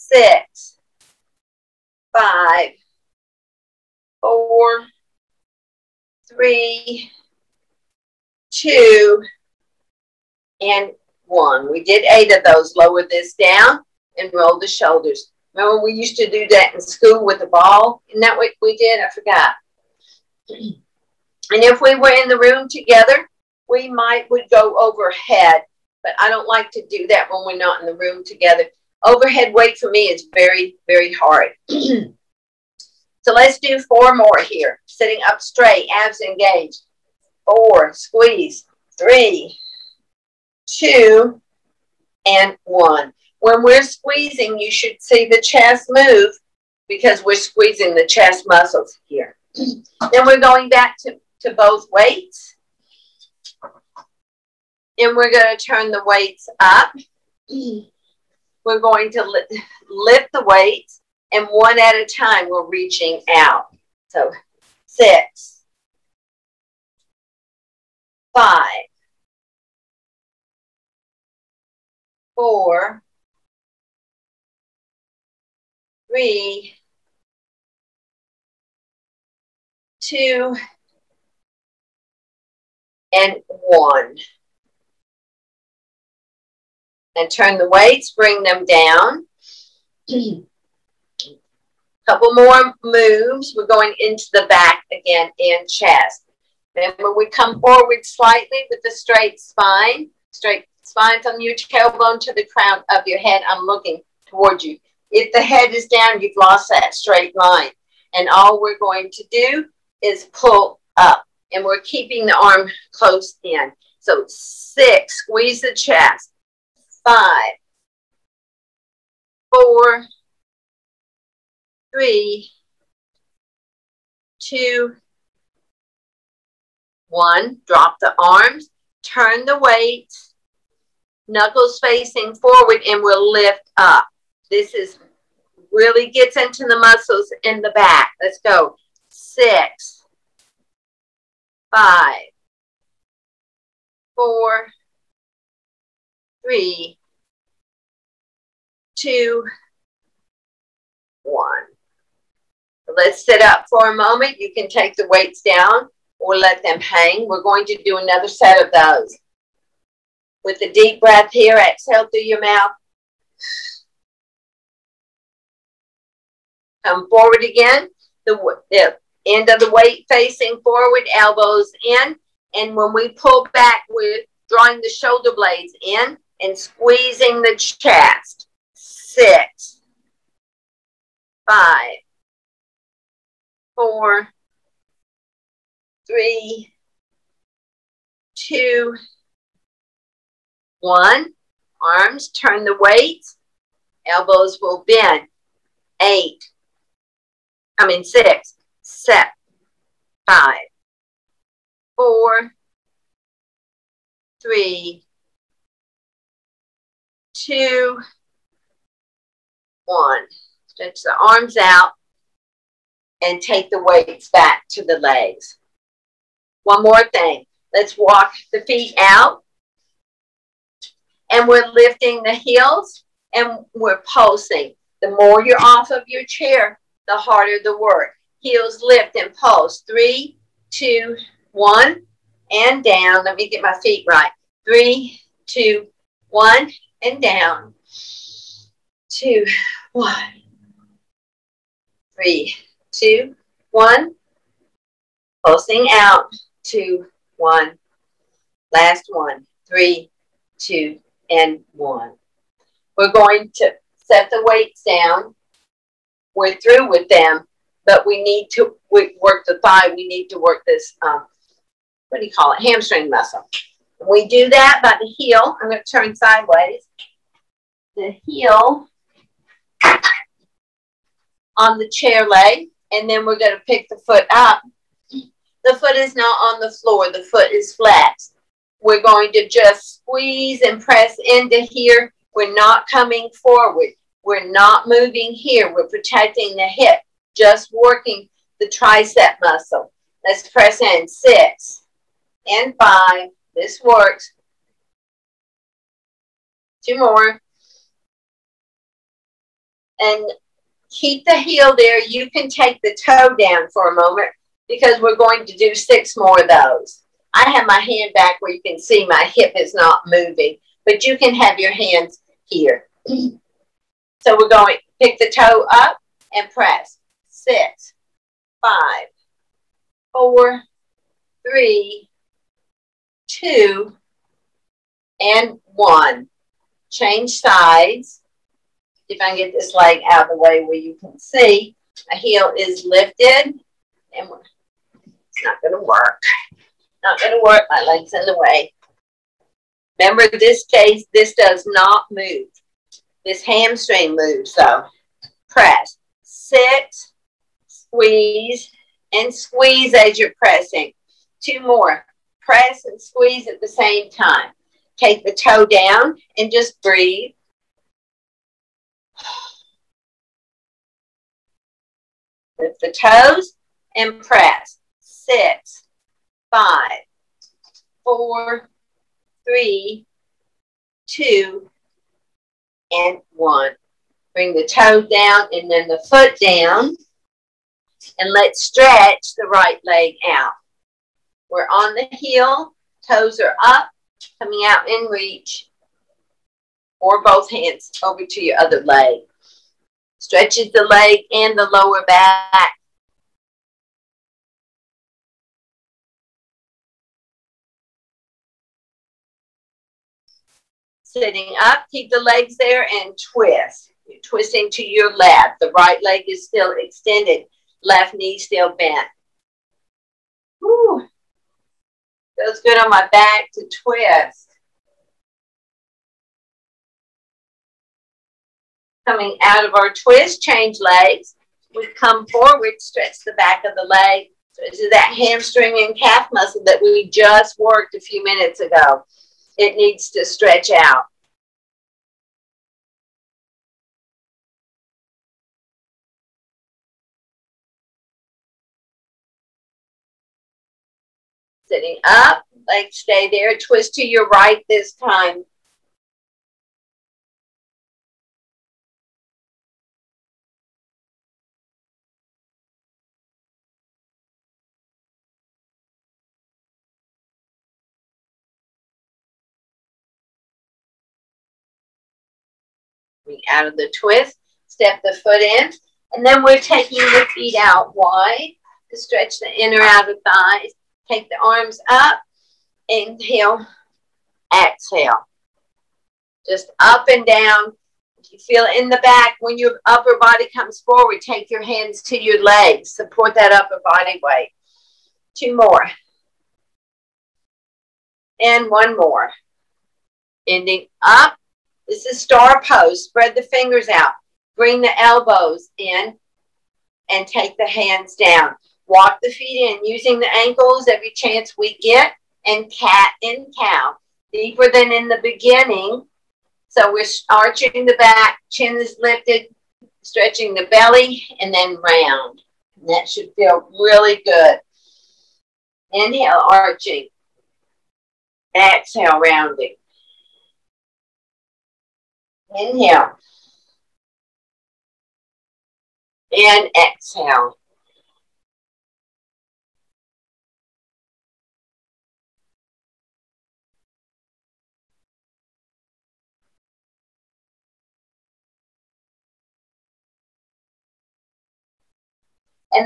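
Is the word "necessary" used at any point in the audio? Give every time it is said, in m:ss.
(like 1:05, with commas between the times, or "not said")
not said.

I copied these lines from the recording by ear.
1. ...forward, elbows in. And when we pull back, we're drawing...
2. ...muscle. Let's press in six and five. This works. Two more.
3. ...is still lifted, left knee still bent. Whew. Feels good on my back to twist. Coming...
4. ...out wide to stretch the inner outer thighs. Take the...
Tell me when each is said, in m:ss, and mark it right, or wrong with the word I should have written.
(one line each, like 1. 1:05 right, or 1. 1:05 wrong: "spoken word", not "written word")
1. 2:50 right
2. 4:49 right
3. 6:46 wrong: "extended", not "lifted"
4. 7:47 right.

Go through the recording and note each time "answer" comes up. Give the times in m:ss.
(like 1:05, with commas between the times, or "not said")
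not said.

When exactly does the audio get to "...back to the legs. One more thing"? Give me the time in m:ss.
3:34.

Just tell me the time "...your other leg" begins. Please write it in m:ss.
6:28.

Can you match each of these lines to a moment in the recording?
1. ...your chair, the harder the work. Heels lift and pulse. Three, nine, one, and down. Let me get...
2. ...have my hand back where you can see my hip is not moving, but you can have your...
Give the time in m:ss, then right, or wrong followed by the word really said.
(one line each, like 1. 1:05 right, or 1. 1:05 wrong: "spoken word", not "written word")
1. 3:46 wrong: "two", not "nine"
2. 5:07 right.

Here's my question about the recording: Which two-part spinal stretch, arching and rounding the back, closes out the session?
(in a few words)
cat and cow.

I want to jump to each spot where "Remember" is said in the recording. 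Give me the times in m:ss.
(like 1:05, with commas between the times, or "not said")
0:15, 5:39.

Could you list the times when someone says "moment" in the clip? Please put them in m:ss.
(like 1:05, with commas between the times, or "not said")
2:33, 5:03.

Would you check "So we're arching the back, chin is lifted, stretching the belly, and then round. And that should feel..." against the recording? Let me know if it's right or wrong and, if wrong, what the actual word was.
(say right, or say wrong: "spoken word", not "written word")
right.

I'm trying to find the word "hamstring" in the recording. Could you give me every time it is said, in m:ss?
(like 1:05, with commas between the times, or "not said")
4:22, 5:43, 7:05.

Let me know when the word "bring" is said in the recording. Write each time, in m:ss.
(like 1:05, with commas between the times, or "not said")
1:28, 6:14, 8:14.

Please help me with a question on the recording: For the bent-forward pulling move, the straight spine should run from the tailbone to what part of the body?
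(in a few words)
crown of your head.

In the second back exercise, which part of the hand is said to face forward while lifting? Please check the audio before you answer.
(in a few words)
Knuckles.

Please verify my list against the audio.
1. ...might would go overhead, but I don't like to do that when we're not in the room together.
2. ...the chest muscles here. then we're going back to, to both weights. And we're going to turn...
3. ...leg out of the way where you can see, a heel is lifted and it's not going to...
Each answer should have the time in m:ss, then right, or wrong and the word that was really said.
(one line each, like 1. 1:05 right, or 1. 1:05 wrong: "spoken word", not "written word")
1. 0:23 right
2. 0:47 right
3. 5:29 right.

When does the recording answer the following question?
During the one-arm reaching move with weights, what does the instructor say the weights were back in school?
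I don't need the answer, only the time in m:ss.
0:17.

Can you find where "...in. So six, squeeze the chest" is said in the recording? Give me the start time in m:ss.
1:53.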